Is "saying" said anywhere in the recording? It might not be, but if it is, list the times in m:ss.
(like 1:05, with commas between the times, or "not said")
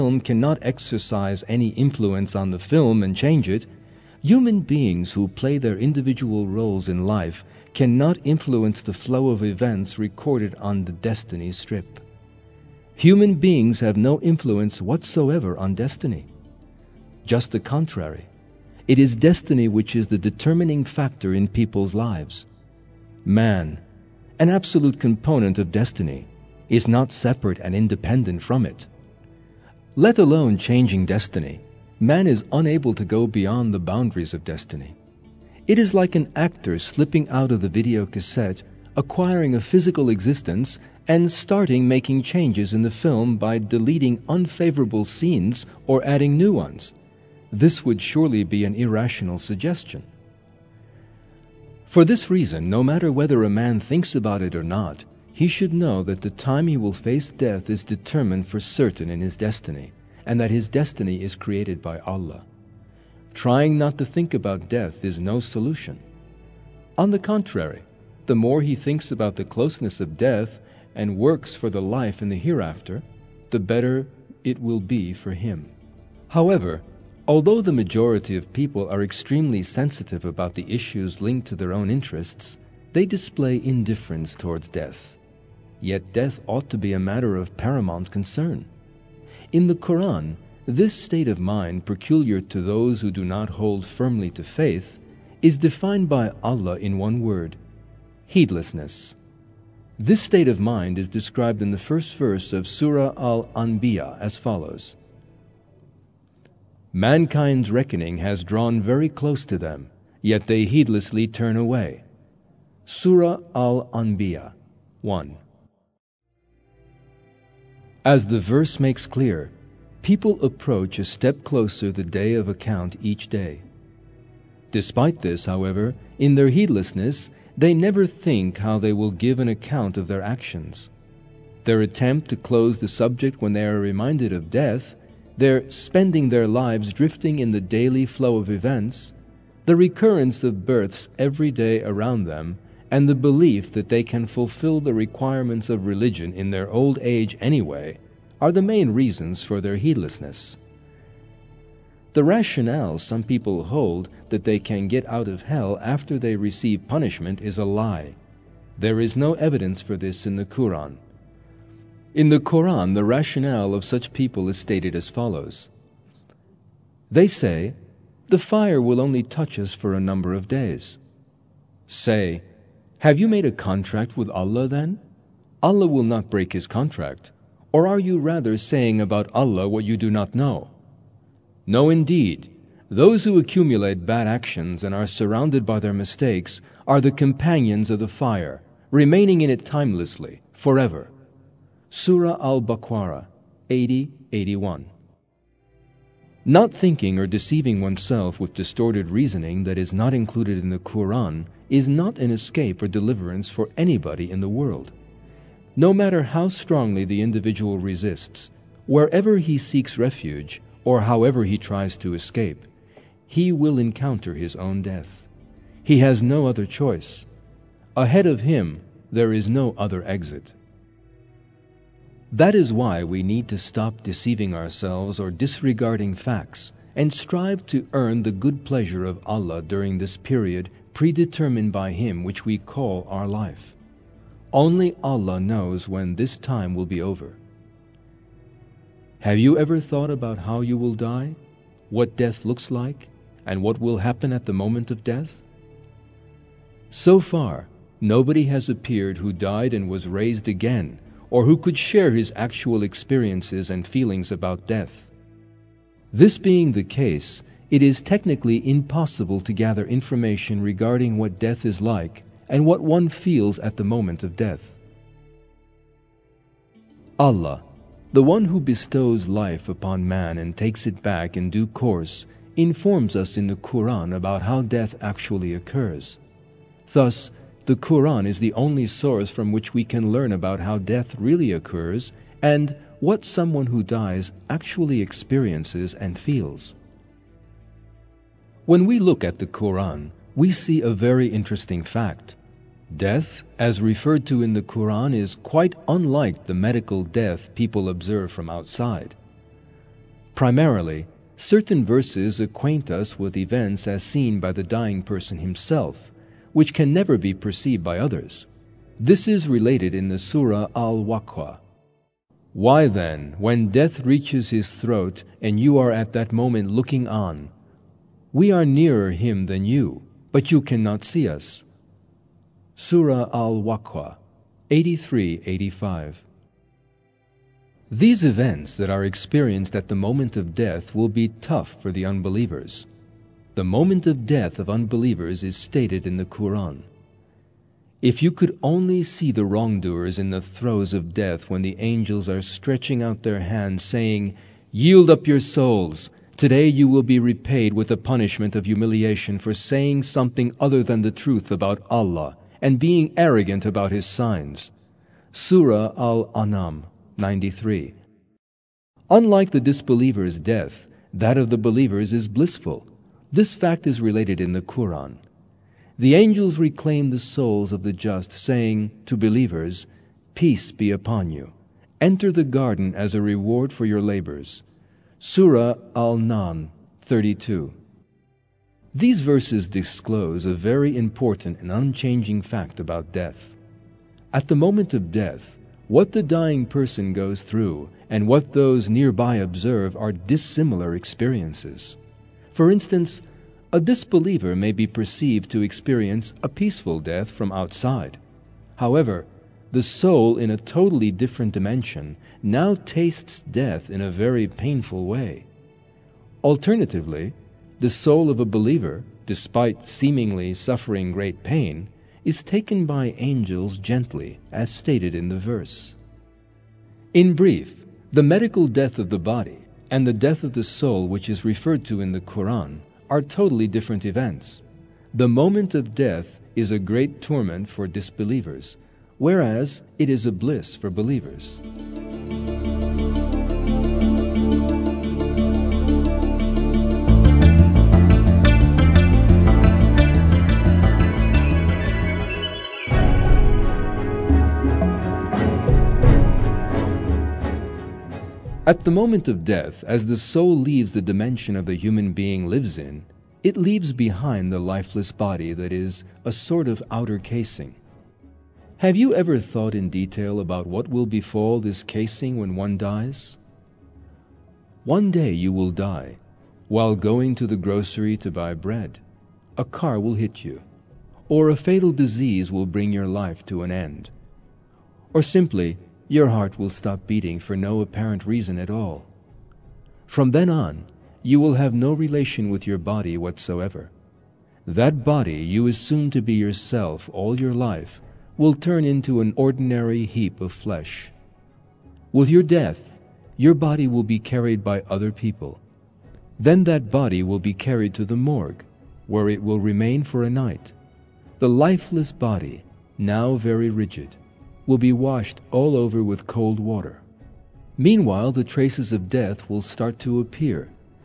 2:58, 5:43, 5:49, 6:08.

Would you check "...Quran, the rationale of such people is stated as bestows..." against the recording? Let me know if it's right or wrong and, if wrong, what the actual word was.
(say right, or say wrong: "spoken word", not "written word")
wrong: "follows", not "bestows".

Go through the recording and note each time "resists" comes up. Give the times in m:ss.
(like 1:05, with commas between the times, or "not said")
3:27.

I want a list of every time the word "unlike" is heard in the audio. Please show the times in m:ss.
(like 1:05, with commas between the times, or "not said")
4:55, 5:59.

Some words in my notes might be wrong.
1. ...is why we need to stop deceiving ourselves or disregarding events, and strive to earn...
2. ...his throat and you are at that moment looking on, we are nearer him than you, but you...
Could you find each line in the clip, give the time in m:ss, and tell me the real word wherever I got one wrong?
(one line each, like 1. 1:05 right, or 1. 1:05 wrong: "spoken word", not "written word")
1. 3:42 wrong: "facts", not "events"
2. 5:14 right.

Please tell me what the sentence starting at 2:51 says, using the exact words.
Say, have you made a contract with Allah then?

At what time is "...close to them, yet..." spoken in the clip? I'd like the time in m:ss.
1:49.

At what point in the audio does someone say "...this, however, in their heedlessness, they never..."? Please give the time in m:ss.
2:05.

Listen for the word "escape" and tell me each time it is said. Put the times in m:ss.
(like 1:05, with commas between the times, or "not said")
3:22, 3:32.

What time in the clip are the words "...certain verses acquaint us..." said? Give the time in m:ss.
5:01.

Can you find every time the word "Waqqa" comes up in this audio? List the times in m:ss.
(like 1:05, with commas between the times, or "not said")
5:11, 5:23.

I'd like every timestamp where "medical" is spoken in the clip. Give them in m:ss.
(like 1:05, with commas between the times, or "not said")
4:56, 6:58.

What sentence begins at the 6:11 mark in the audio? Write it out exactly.
Enter the garden as a reward for your labors.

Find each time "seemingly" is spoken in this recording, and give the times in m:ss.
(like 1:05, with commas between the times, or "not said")
6:49.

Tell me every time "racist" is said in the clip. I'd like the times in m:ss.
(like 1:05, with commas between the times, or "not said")
not said.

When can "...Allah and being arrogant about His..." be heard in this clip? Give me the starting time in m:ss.
5:51.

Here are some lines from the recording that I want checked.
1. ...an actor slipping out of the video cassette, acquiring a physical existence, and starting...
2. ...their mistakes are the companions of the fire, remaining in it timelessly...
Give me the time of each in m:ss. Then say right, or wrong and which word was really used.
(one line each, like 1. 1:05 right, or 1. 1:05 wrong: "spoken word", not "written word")
1. 0:36 right
2. 3:05 right.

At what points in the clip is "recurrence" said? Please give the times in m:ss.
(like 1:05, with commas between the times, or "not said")
2:19.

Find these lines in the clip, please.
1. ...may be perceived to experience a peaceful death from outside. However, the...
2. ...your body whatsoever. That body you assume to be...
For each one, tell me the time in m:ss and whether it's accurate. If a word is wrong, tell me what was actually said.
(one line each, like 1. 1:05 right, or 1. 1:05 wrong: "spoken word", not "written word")
1. 6:34 right
2. 8:02 right.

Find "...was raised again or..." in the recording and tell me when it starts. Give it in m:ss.
4:09.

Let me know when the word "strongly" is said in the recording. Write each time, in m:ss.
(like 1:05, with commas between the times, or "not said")
3:26.